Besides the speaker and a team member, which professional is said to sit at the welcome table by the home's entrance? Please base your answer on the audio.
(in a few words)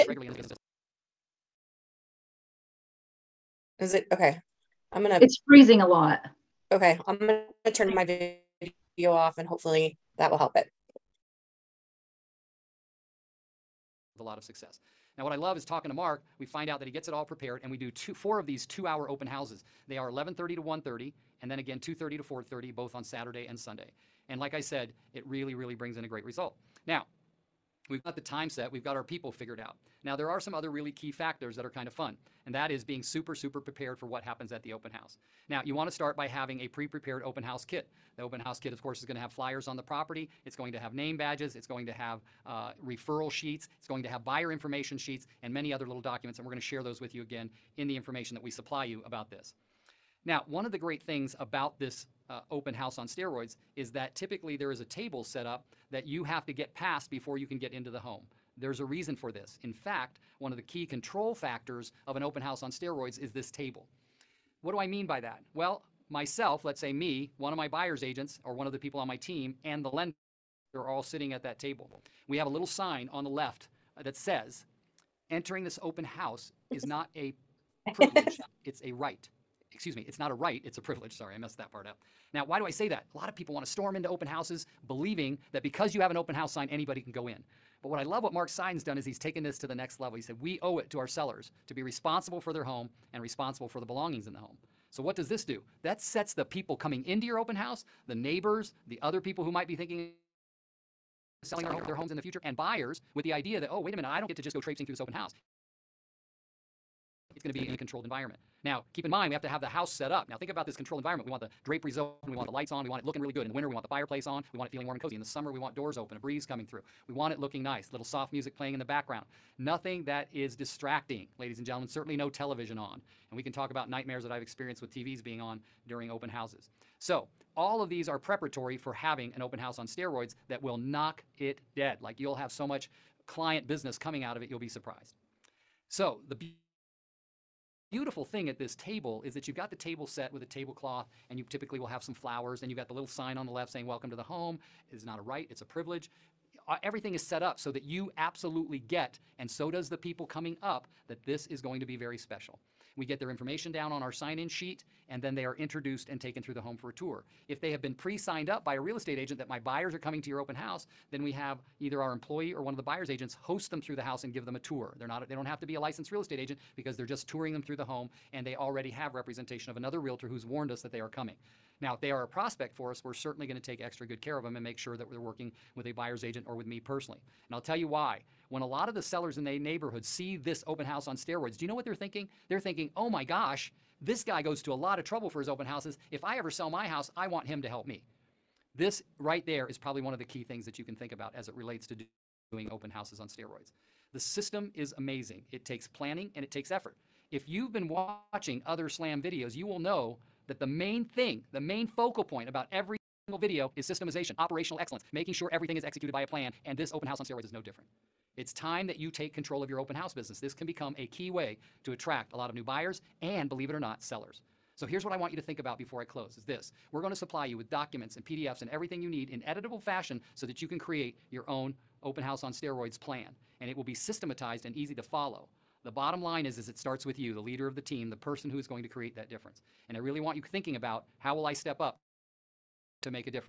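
The lender.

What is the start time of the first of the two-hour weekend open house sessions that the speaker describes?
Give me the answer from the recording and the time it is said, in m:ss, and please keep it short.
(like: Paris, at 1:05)
11:30, at 0:20.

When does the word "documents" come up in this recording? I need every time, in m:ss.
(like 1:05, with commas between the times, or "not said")
0:45, 3:37.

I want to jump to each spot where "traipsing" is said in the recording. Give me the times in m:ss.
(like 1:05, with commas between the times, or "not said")
1:44.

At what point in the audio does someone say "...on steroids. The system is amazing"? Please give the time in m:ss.
3:13.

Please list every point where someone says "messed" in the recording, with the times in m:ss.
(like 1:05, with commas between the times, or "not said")
1:21.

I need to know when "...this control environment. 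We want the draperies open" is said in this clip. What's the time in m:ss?
1:50.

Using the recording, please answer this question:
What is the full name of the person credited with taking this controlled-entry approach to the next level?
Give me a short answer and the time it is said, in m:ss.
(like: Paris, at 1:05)
Mark Seiden, at 1:28.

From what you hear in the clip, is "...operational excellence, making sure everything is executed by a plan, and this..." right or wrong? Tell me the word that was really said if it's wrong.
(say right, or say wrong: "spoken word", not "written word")
right.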